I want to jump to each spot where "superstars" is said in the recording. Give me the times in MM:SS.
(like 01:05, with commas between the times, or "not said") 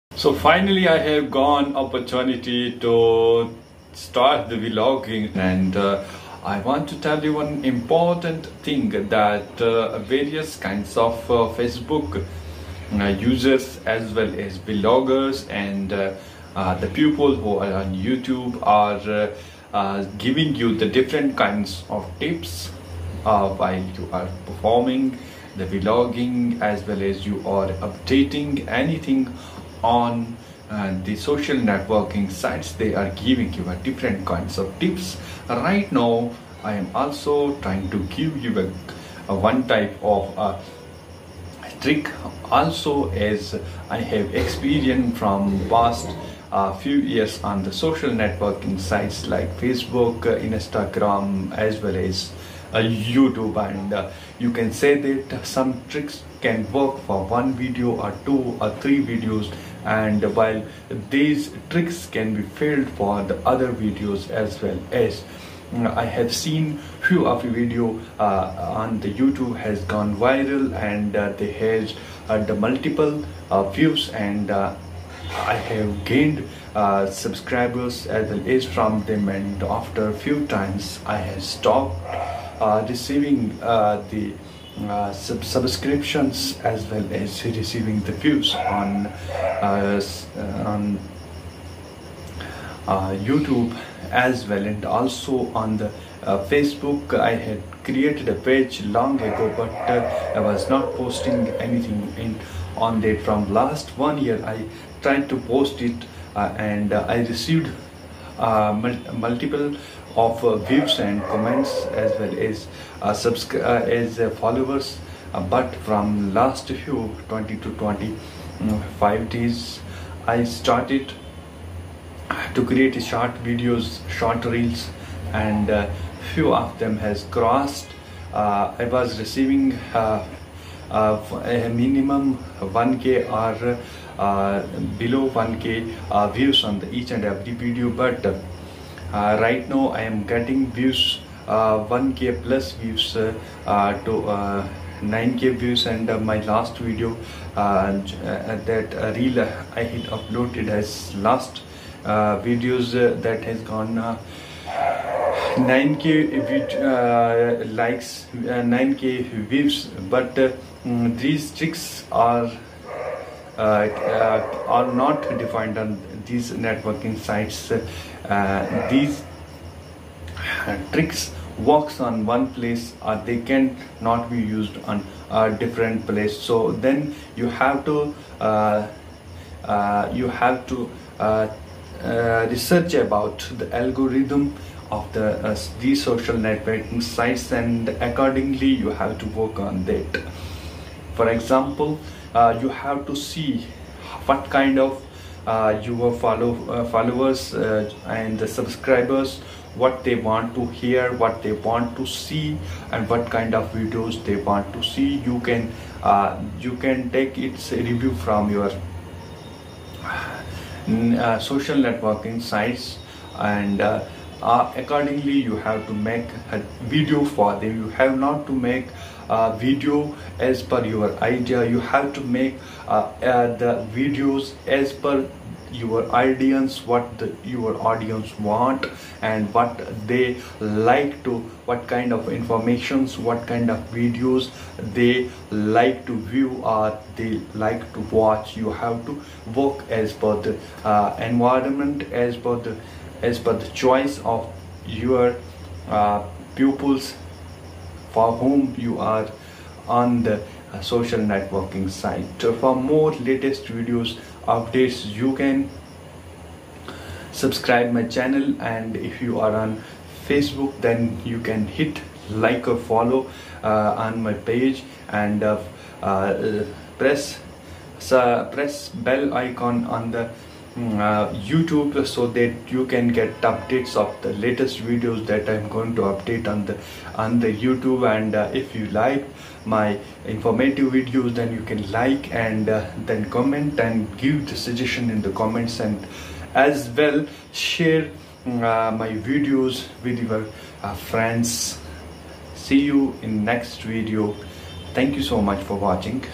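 not said.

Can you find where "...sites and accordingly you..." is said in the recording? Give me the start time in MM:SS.
03:07.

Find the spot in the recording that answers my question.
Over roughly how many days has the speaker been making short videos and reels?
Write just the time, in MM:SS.
01:57.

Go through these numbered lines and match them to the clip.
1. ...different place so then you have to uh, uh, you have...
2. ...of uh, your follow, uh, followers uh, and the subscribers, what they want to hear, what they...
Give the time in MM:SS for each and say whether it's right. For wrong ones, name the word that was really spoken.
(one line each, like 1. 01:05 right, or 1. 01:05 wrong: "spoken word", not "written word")
1. 02:55 right
2. 03:14 right.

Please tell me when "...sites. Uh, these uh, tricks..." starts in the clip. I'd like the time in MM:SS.
02:47.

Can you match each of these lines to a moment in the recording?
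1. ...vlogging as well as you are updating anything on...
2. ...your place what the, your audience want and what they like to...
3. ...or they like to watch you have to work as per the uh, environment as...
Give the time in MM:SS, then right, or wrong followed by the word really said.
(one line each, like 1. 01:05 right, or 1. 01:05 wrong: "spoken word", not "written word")
1. 00:25 right
2. 03:45 wrong: "audience", not "place"
3. 03:56 right.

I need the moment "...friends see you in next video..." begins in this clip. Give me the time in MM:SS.
04:50.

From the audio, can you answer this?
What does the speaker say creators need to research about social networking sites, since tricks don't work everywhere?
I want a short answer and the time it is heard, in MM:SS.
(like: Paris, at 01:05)
The algorithm, at 03:03.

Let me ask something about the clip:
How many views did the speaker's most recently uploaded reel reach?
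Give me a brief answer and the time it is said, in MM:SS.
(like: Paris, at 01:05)
9k, at 02:38.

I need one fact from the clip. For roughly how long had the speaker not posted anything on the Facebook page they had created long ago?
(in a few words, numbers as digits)
1 year.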